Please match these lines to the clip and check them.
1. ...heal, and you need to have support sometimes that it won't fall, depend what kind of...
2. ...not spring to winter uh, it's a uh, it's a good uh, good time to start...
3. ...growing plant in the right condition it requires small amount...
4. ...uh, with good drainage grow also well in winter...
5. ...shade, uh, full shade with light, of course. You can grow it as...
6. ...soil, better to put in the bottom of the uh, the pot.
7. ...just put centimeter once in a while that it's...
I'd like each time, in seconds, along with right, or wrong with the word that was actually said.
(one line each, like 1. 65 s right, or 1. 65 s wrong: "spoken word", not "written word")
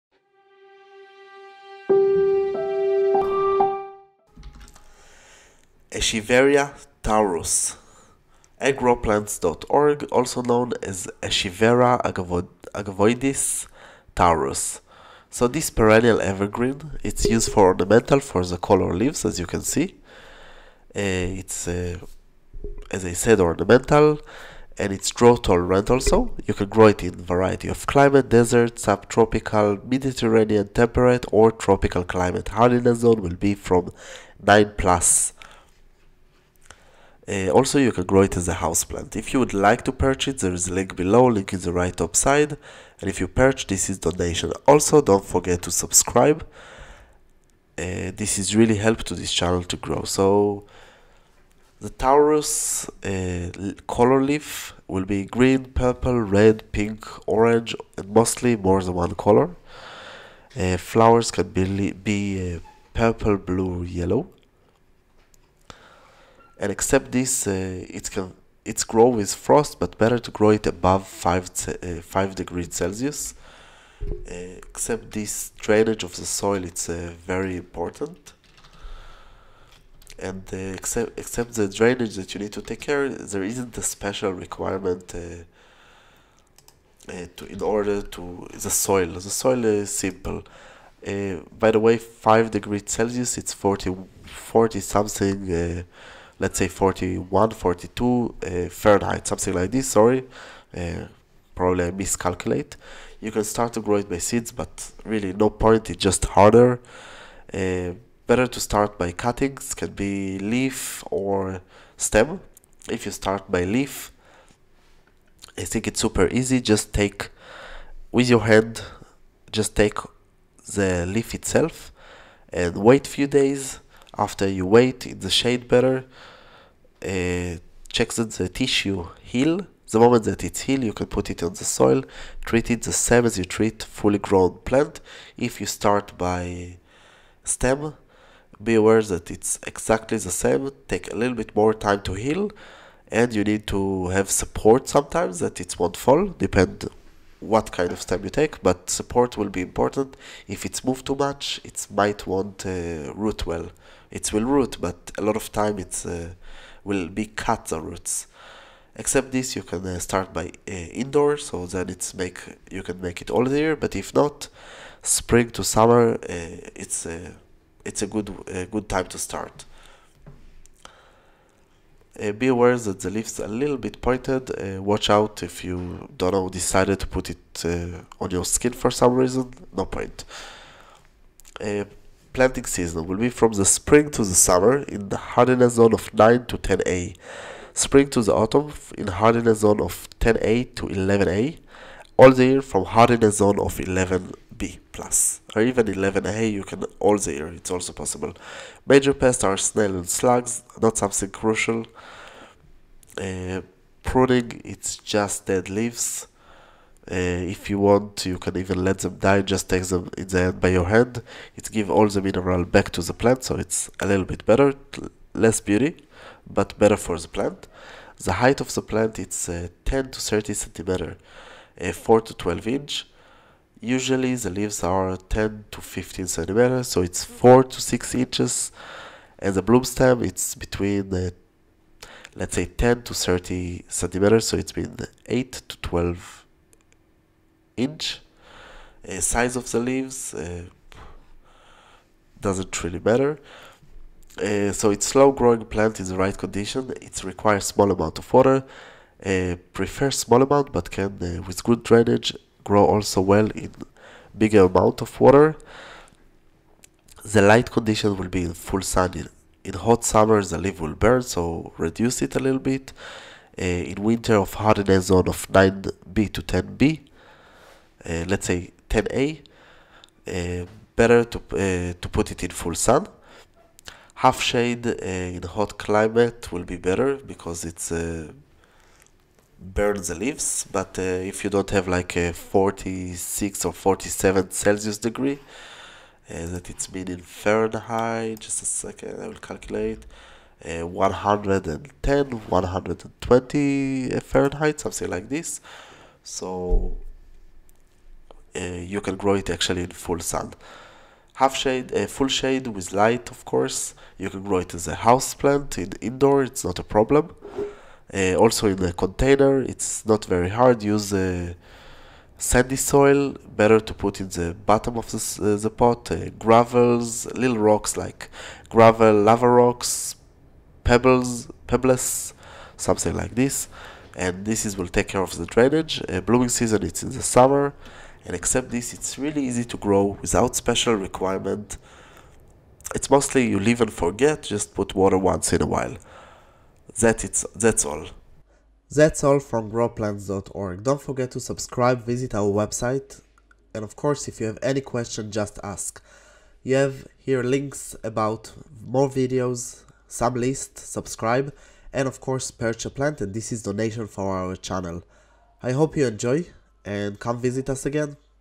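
1. 142 s right
2. 164 s wrong: "summer", not "winter"
3. 245 s right
4. 251 s wrong: "bigger", not "winter"
5. 301 s right
6. 312 s right
7. 334 s wrong: "water", not "centimeter".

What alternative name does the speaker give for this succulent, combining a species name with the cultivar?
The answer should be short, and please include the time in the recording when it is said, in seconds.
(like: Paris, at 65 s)
Echeveria agavoides taurus, at 11 s.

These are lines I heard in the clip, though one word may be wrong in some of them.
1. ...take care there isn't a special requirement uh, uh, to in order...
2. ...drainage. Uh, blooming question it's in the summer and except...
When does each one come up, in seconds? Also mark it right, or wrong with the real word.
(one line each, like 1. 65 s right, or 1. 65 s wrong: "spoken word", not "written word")
1. 82 s right
2. 325 s wrong: "season", not "question".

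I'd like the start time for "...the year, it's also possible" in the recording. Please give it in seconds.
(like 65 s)
197 s.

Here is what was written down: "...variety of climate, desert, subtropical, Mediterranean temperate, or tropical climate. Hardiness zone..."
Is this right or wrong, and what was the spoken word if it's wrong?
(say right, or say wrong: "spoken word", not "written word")
right.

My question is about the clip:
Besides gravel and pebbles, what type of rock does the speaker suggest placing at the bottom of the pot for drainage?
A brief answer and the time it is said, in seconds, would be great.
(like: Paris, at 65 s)
Lava rocks, at 319 s.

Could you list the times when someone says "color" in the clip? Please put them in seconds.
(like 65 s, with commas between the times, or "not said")
18 s, 53 s, 59 s.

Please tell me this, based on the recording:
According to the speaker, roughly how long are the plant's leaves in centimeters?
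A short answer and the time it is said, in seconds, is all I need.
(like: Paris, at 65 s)
10 to 15 centimeters, at 225 s.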